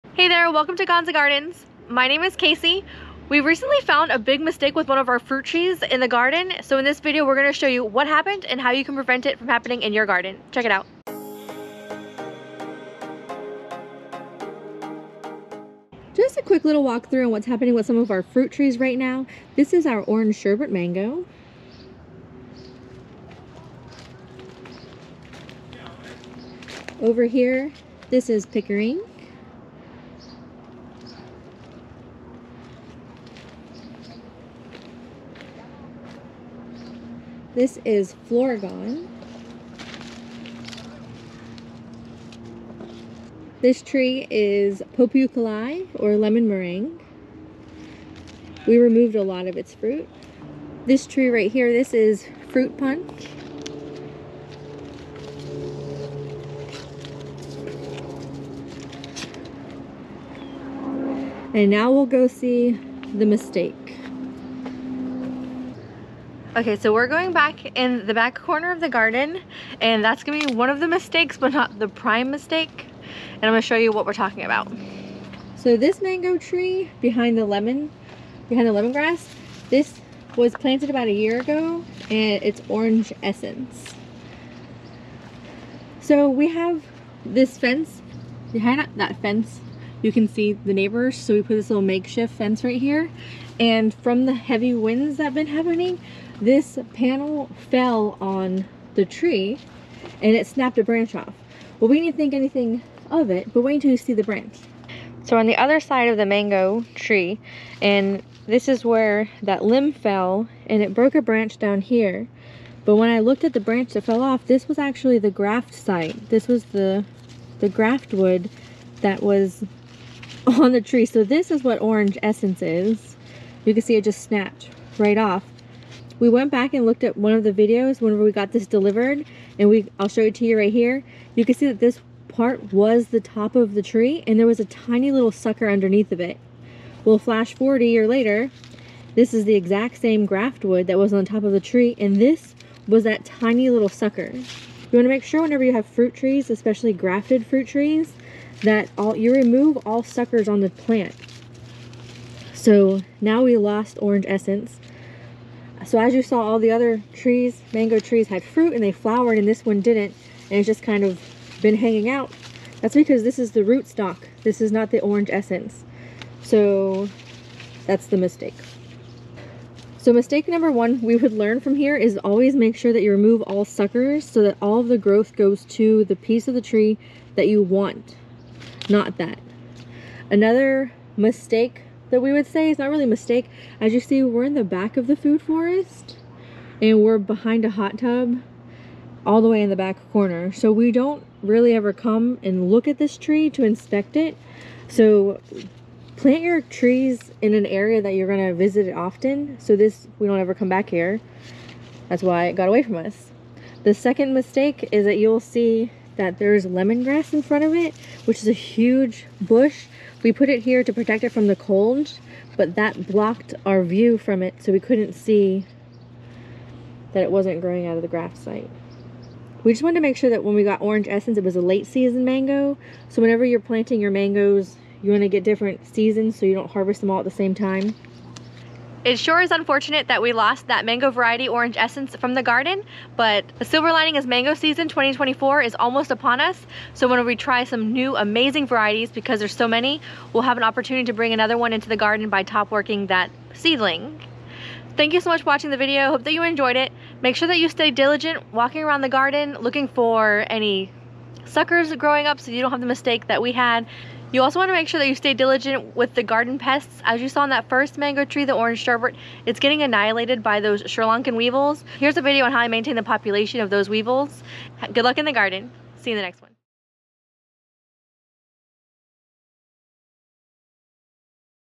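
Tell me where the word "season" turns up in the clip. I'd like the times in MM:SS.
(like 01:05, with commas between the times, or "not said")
03:41, 03:45, 03:54.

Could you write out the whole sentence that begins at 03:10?
So we don't really ever come and look at this tree to inspect it.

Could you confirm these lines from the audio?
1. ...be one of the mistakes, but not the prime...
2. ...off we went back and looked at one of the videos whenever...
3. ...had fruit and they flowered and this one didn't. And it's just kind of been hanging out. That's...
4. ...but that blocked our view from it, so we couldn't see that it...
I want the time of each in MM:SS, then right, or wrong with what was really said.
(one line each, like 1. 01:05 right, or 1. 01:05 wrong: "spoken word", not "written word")
1. 01:10 right
2. 02:05 right
3. 02:38 right
4. 03:32 right.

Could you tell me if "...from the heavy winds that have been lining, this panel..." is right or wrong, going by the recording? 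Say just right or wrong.
wrong.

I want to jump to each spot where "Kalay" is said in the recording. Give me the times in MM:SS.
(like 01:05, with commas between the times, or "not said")
00:45.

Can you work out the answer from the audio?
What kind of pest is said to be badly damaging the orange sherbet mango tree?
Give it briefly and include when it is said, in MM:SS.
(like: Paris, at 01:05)
Sri Lankan weevils, at 04:20.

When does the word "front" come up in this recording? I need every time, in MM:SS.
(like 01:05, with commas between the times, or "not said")
03:27.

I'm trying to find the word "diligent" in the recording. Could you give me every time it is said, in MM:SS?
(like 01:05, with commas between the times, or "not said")
04:07, 04:15.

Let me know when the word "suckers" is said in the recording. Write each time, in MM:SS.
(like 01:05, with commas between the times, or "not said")
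02:15, 02:23, 02:30, 02:53, 04:11.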